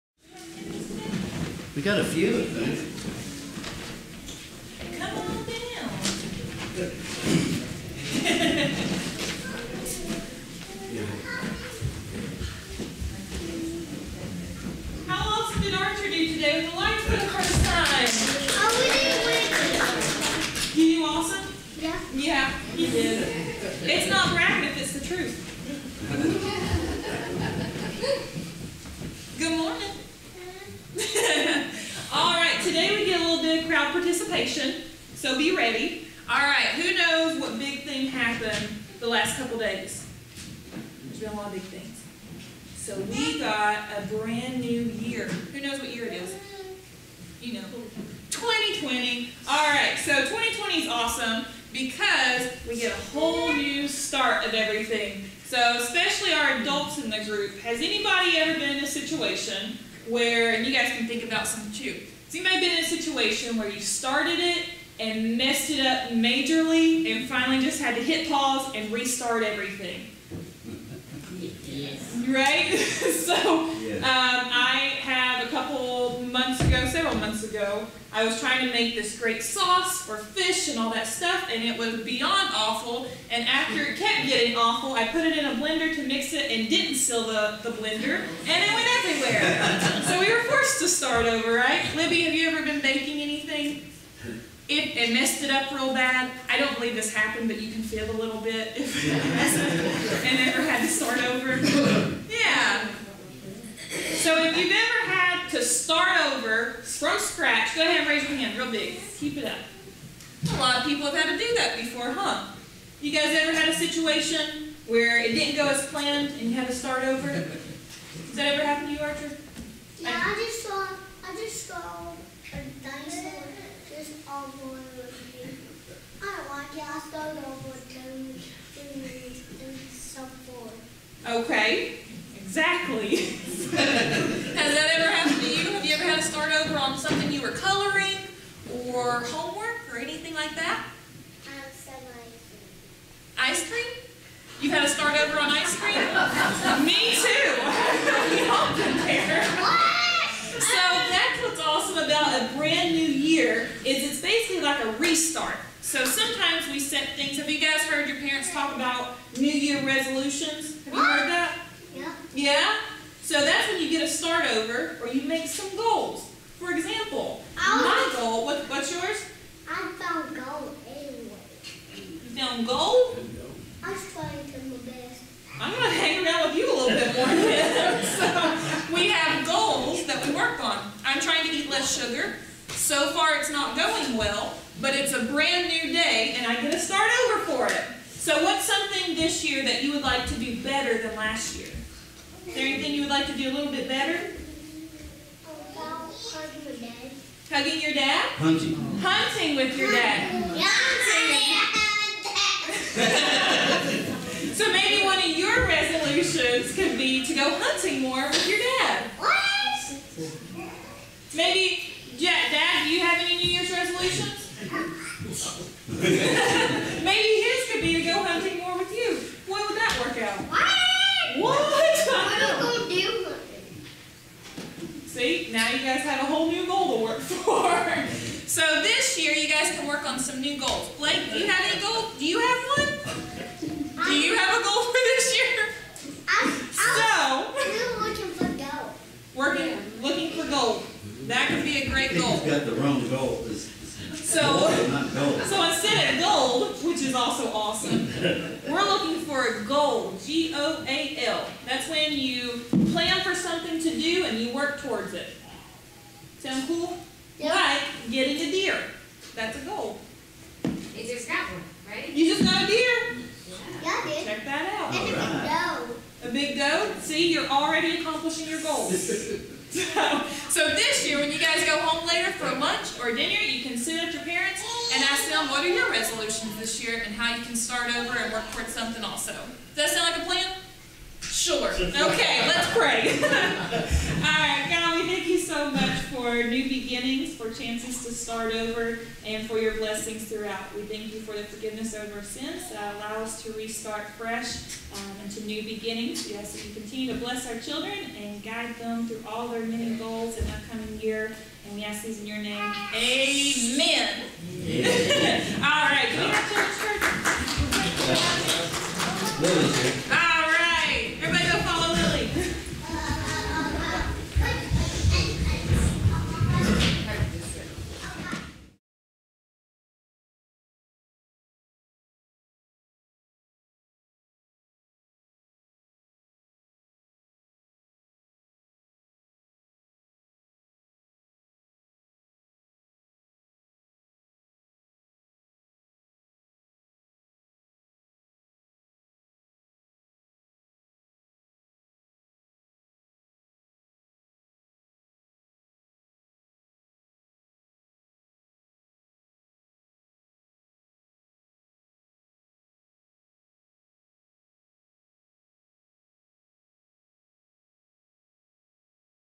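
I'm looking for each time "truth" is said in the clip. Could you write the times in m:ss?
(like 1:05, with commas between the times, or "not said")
0:25.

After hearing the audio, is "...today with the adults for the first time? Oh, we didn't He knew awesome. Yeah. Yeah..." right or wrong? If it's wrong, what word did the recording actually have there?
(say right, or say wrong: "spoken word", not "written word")
wrong: "lights", not "adults".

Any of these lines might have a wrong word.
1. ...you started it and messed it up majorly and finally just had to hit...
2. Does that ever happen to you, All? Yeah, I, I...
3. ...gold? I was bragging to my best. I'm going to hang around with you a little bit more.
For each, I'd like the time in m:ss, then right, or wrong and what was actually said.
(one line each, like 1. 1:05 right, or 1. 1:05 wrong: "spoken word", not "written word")
1. 1:03 right
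2. 1:57 wrong: "Archer", not "All"
3. 2:52 wrong: "trying", not "bragging".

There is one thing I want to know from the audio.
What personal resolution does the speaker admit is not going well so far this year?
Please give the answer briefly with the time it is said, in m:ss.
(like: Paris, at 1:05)
Eat less sugar, at 3:01.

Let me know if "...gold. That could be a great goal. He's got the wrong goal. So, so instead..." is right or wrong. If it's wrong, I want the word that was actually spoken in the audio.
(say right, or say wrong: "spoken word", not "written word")
right.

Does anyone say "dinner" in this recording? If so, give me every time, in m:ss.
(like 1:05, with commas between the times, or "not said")
4:33.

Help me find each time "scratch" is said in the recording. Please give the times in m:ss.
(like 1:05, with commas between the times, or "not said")
1:47.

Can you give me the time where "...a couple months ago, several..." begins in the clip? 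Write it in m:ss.
1:15.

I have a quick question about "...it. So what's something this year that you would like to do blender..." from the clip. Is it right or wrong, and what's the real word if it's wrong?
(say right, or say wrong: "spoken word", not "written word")
wrong: "better", not "blender".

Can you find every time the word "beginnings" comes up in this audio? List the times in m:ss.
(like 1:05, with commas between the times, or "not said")
4:46, 4:55.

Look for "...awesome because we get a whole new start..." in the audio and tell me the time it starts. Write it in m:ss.
0:50.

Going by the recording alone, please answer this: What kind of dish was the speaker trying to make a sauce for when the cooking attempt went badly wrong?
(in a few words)
Fish.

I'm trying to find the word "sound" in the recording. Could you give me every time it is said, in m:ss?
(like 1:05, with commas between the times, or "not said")
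4:16, 4:39.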